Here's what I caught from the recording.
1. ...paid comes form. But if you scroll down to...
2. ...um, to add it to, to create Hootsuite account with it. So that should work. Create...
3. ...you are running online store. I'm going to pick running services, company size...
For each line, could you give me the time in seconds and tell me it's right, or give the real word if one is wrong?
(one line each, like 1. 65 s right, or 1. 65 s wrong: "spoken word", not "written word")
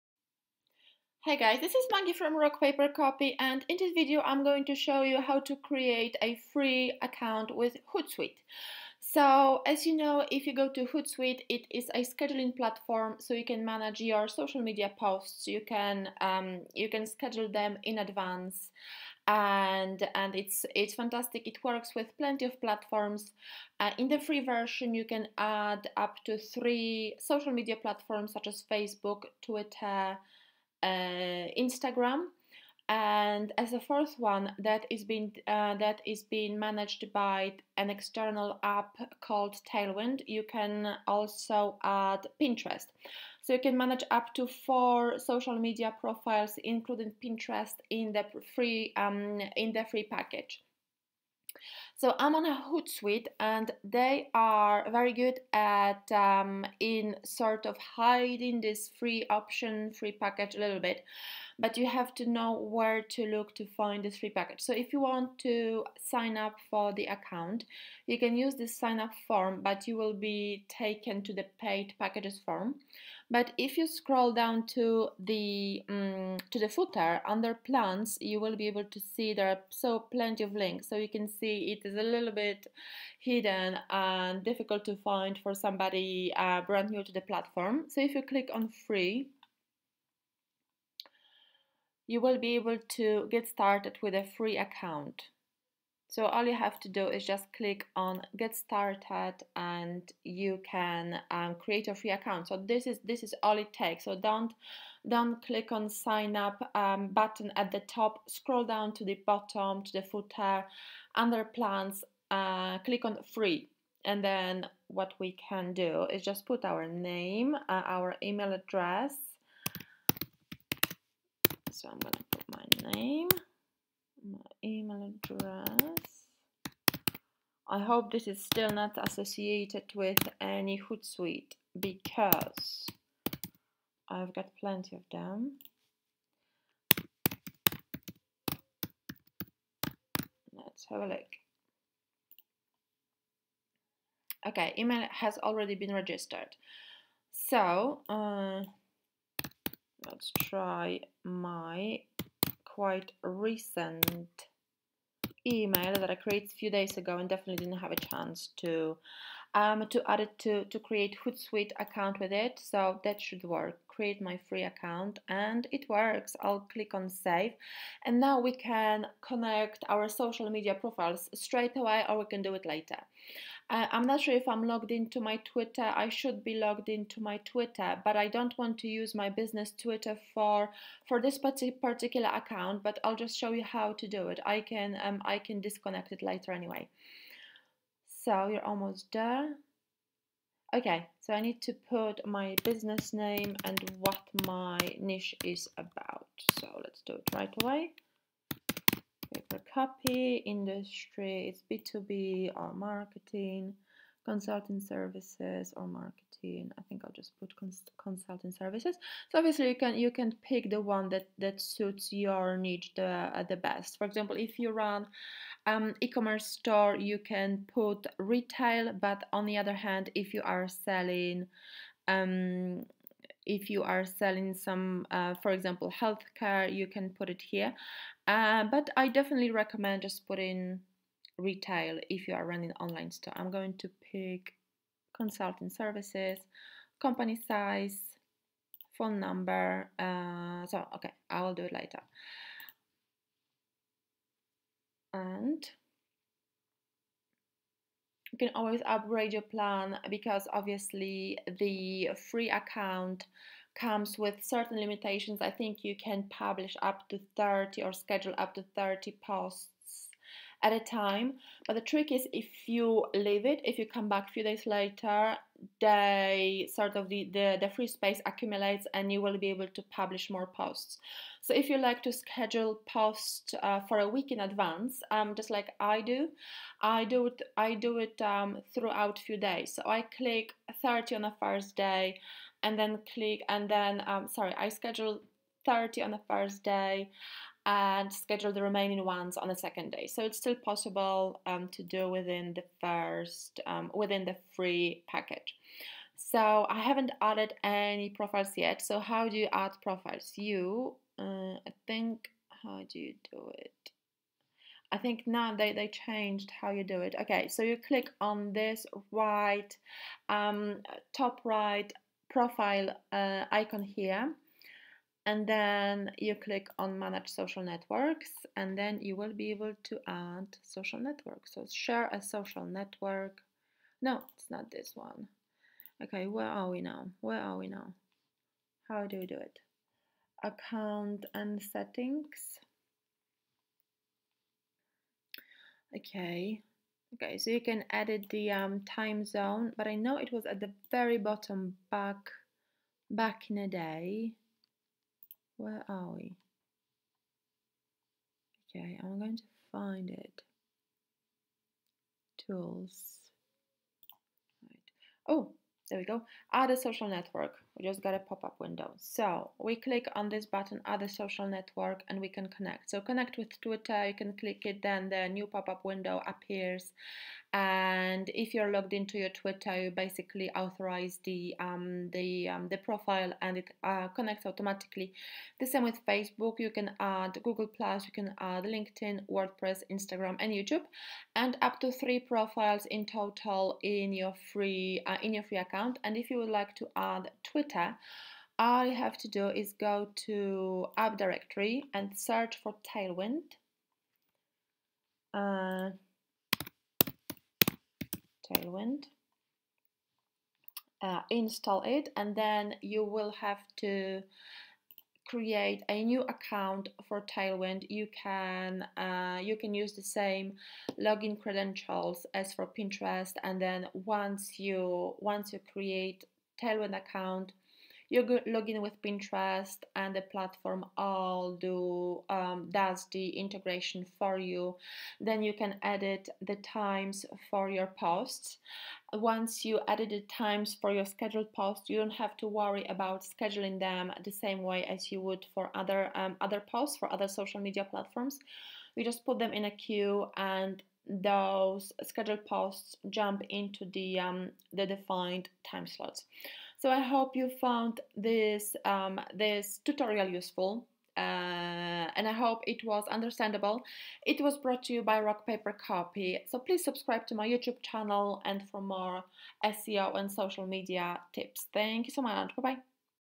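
1. 71 s wrong: "packages", not "comes"
2. 159 s right
3. 232 s wrong: "consulting", not "running".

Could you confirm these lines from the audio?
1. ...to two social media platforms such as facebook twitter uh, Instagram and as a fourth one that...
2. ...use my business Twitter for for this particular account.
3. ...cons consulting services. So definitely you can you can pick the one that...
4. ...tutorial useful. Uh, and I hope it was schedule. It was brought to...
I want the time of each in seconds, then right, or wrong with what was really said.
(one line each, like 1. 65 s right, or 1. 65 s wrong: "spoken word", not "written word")
1. 26 s wrong: "three", not "two"
2. 178 s right
3. 207 s wrong: "obviously", not "definitely"
4. 449 s wrong: "understandable", not "schedule".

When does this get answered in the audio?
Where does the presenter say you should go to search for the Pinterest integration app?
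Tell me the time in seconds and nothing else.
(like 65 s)
390 s.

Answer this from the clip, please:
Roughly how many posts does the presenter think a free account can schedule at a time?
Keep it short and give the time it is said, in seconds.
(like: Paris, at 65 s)
30, at 258 s.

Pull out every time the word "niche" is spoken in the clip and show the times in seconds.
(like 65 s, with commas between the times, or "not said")
194 s, 212 s.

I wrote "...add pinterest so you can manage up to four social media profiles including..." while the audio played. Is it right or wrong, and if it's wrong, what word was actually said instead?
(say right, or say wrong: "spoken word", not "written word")
right.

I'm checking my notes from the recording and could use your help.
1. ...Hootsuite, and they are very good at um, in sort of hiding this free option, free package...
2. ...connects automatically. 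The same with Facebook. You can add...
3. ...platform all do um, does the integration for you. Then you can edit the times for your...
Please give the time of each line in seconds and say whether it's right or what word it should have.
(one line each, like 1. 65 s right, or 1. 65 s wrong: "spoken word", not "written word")
1. 52 s right
2. 374 s right
3. 420 s right.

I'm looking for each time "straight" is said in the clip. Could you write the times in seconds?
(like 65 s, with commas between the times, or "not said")
171 s.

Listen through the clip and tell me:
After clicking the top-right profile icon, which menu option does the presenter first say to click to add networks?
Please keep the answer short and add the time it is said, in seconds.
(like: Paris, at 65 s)
manage social networks, at 316 s.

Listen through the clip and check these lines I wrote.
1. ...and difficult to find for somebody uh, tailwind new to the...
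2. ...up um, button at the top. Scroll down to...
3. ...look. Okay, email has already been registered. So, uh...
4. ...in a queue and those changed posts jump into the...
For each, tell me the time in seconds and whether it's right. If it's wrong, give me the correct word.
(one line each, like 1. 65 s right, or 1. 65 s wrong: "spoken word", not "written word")
1. 83 s wrong: "brand", not "tailwind"
2. 106 s right
3. 141 s right
4. 439 s wrong: "scheduled", not "changed".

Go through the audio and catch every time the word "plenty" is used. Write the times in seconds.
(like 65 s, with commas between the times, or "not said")
22 s, 80 s, 134 s.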